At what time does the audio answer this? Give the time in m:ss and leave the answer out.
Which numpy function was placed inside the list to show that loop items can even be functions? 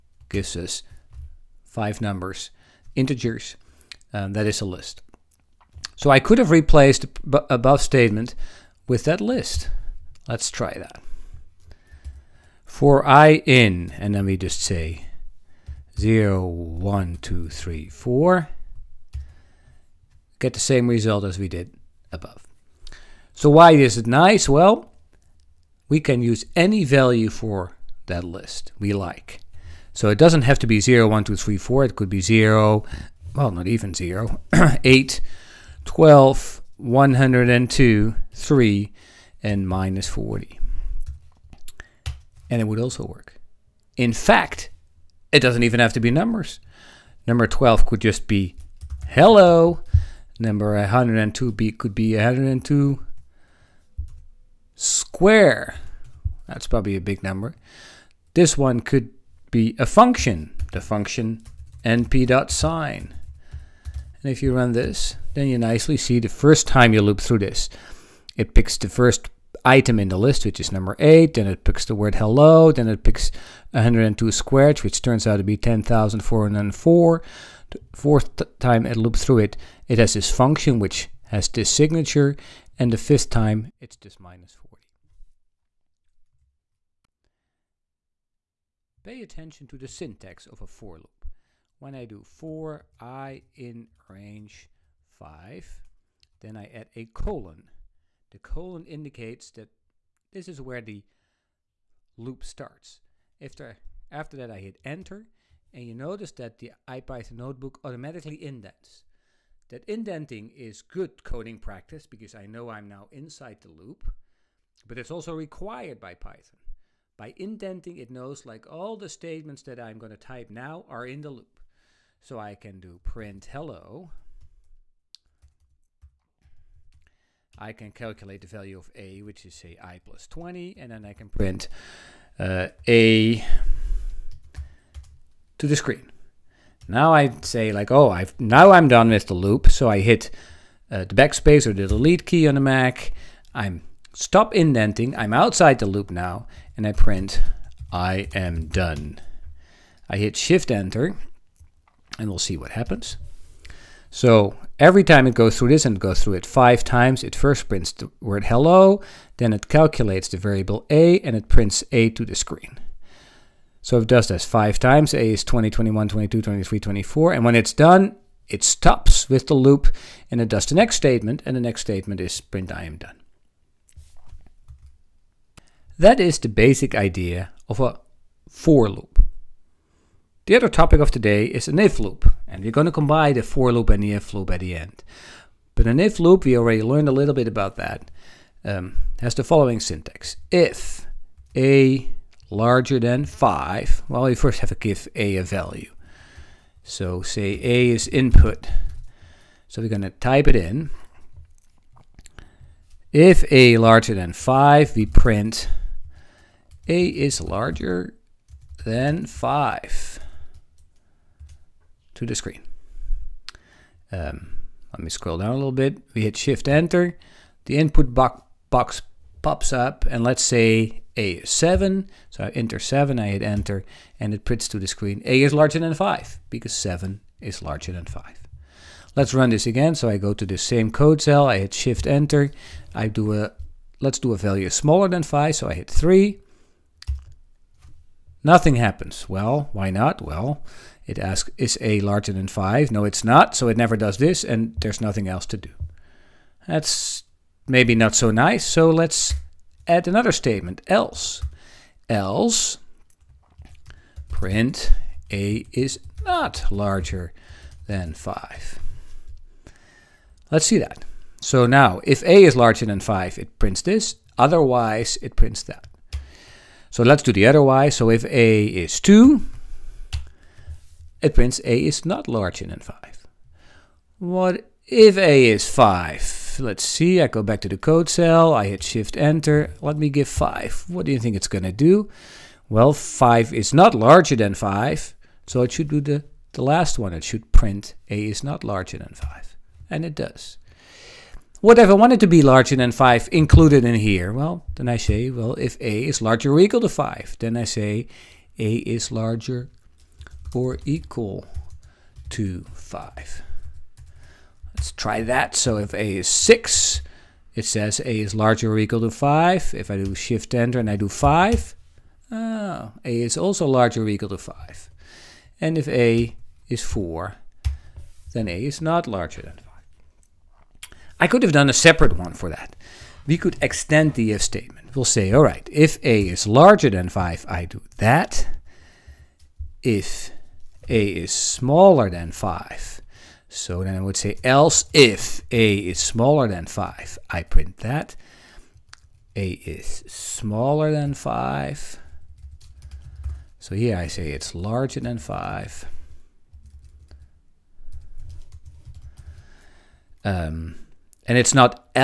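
1:01.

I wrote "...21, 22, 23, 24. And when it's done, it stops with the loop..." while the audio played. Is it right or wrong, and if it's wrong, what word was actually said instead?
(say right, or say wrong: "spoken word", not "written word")
right.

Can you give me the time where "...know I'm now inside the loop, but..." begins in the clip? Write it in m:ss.
1:52.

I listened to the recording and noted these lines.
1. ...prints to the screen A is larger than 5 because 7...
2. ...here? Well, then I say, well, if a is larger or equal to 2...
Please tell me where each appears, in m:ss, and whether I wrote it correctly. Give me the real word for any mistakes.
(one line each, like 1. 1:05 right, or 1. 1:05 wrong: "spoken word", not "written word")
1. 3:44 right
2. 4:53 wrong: "5", not "2".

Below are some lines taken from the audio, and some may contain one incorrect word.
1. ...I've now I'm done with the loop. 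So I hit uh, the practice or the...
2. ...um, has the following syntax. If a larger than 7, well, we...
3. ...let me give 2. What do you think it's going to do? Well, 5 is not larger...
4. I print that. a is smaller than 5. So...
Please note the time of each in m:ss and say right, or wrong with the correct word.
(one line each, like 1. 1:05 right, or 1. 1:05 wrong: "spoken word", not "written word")
1. 2:18 wrong: "backspace", not "practice"
2. 3:08 wrong: "5", not "7"
3. 4:39 wrong: "5", not "2"
4. 5:37 right.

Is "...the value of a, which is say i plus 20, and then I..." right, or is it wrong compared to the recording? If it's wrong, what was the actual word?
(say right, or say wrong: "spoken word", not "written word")
right.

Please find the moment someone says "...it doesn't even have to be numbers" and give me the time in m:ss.
0:45.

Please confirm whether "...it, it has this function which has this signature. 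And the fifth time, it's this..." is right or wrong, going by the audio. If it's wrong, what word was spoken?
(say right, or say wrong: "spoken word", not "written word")
right.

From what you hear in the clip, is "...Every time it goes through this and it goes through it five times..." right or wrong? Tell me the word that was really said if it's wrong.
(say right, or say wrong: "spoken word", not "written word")
right.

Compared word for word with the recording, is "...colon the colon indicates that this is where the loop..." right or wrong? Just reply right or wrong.
right.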